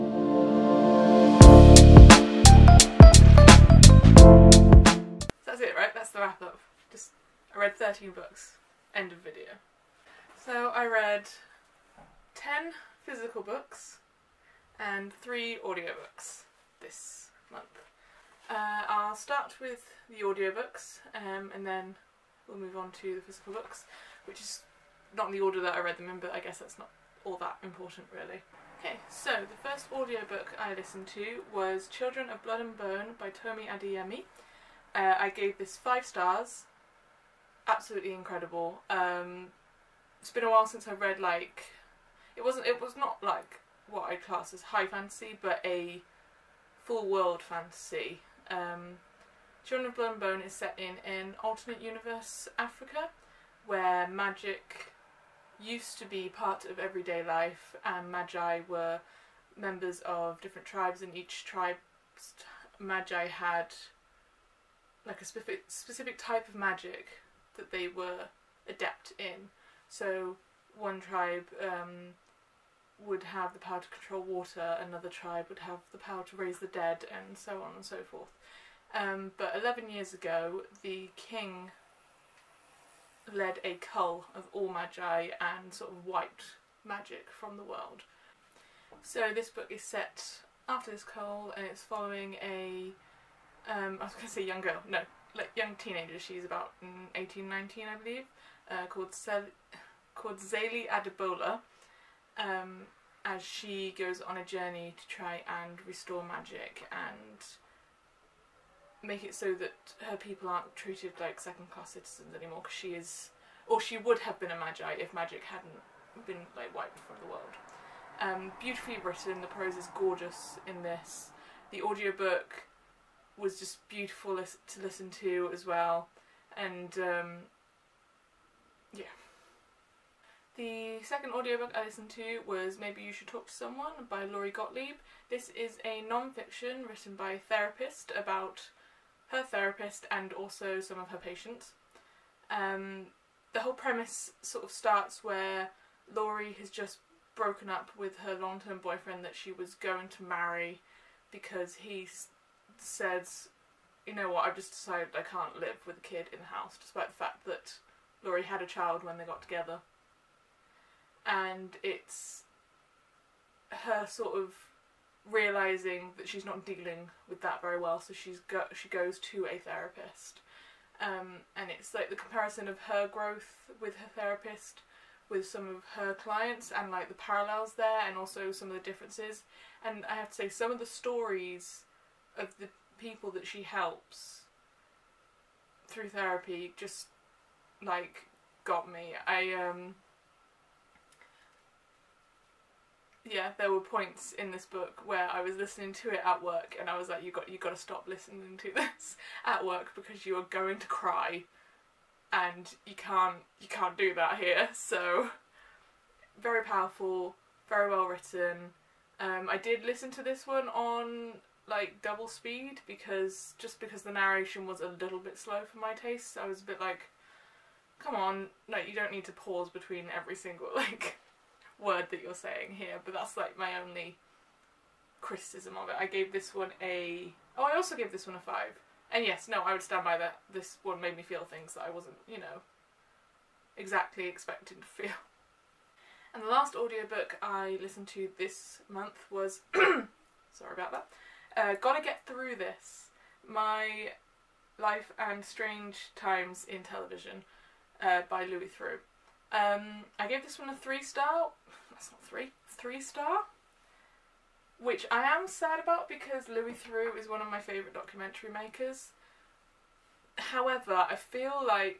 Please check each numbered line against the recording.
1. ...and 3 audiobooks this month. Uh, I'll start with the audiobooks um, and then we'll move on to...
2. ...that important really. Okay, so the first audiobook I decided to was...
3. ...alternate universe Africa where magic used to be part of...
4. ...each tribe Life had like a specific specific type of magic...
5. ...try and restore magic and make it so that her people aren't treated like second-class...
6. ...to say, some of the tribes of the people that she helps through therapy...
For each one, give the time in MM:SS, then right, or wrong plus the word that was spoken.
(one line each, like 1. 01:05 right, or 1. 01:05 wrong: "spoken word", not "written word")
1. 00:14 right
2. 00:27 wrong: "listened", not "decided"
3. 00:51 right
4. 01:01 wrong: "Magi", not "Life"
5. 01:45 right
6. 03:00 wrong: "stories", not "tribes".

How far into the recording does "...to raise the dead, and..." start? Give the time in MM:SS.
01:16.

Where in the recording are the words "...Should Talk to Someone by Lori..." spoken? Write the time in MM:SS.
02:13.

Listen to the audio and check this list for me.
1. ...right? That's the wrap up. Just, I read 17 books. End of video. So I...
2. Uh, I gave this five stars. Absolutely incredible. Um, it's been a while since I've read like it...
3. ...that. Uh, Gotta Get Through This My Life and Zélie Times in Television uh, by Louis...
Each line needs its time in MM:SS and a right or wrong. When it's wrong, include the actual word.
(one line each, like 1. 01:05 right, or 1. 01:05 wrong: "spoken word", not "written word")
1. 00:05 wrong: "13", not "17"
2. 00:34 right
3. 04:00 wrong: "Strange", not "Zélie".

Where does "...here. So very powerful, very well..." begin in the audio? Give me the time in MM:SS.
03:24.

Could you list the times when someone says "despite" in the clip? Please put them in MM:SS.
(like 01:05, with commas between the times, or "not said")
02:36.